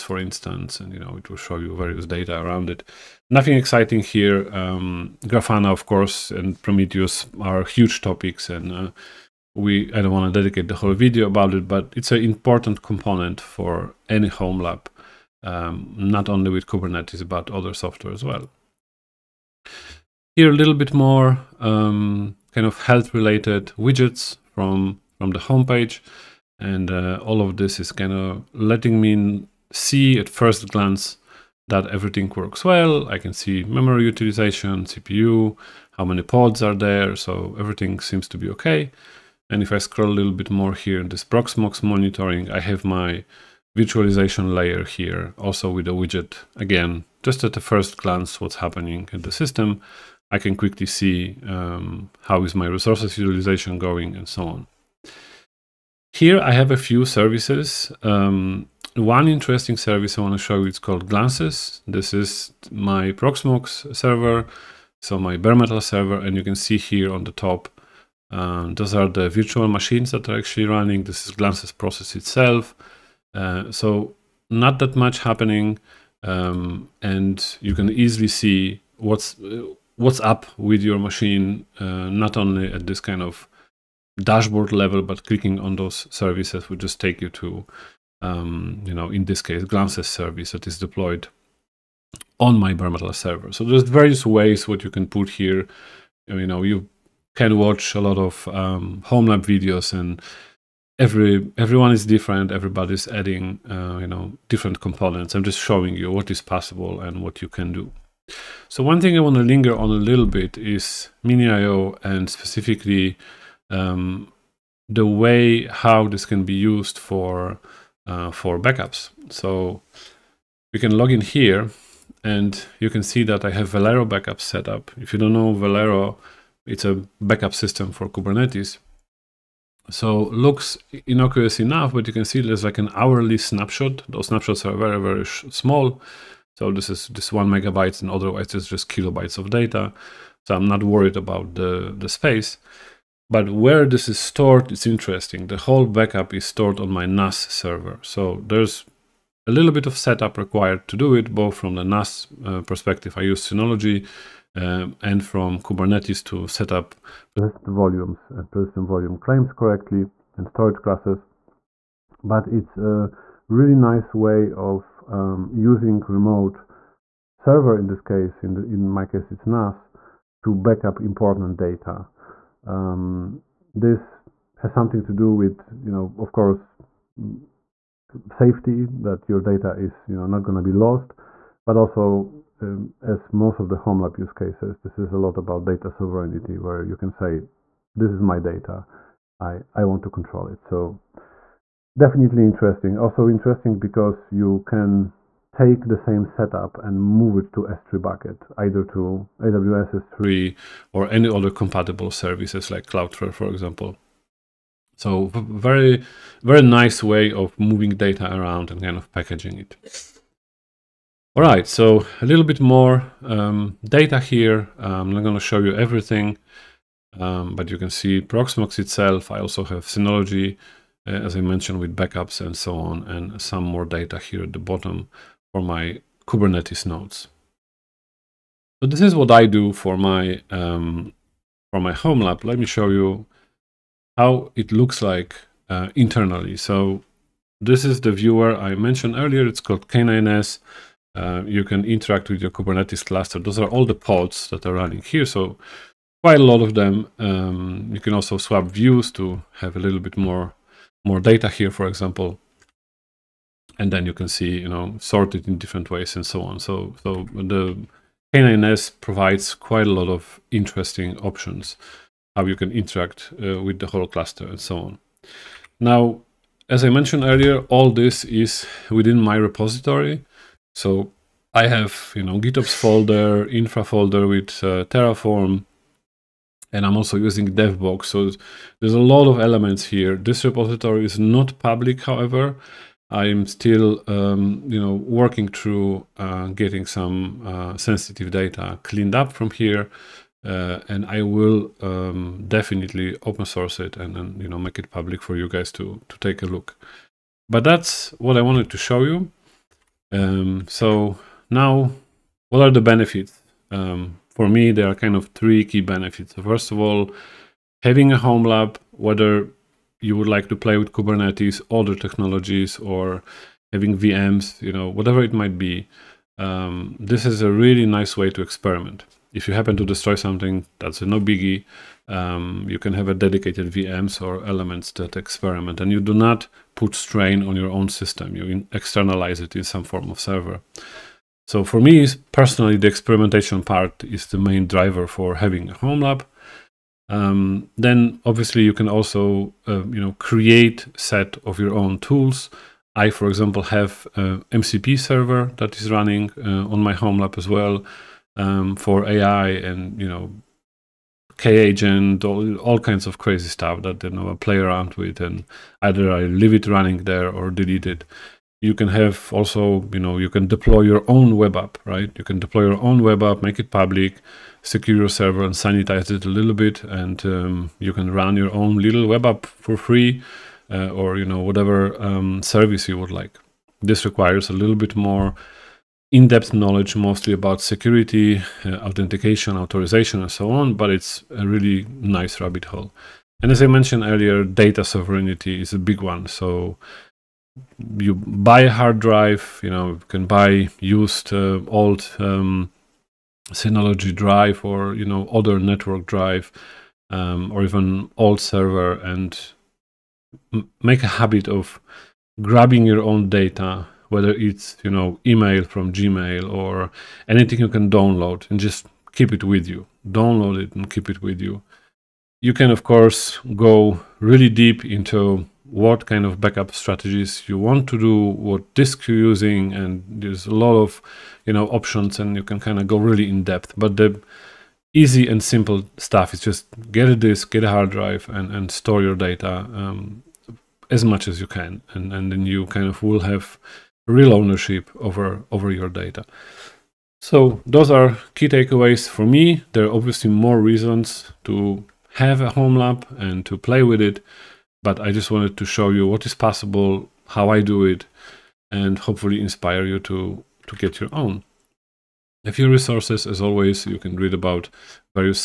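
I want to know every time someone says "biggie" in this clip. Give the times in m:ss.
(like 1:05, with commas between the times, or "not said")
5:21.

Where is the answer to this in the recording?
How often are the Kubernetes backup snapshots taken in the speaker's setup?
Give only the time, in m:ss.
2:12.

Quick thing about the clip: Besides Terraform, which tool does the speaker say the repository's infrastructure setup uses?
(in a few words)
DevBox.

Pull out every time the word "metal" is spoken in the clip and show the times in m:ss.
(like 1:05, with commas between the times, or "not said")
1:05, 1:32.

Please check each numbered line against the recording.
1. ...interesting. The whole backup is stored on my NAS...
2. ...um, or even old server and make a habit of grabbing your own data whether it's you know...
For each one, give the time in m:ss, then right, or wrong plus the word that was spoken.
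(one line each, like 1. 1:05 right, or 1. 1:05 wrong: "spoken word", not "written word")
1. 2:24 right
2. 6:37 right.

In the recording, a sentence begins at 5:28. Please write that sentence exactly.
You externalize it in some form of server.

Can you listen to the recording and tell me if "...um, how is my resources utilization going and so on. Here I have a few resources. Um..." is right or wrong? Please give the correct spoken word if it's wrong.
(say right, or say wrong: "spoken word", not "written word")
wrong: "services", not "resources".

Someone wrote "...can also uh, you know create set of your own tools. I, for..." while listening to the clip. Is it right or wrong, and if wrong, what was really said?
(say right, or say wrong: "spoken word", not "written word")
right.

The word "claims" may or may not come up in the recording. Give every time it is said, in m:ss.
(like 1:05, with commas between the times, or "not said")
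2:39.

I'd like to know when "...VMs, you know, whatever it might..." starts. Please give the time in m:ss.
5:13.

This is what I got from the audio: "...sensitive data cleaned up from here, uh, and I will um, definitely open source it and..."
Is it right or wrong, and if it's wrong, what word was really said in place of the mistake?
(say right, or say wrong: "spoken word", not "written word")
right.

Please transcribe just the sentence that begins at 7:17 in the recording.
So those are key takeaways for me.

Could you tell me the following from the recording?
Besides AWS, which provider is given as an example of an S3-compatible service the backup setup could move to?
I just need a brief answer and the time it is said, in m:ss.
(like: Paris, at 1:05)
Cloudflare, at 3:22.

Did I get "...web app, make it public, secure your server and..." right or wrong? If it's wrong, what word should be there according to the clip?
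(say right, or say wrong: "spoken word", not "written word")
right.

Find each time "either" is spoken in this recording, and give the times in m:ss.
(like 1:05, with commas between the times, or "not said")
3:18, 5:55.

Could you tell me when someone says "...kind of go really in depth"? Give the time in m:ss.
7:02.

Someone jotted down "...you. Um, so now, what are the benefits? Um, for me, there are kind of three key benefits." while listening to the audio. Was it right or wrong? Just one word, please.
right.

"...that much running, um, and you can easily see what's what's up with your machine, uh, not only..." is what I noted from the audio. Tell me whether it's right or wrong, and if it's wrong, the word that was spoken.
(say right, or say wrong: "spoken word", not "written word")
wrong: "happening", not "running".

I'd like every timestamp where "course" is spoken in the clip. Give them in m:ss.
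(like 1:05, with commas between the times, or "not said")
0:05, 2:56, 6:52.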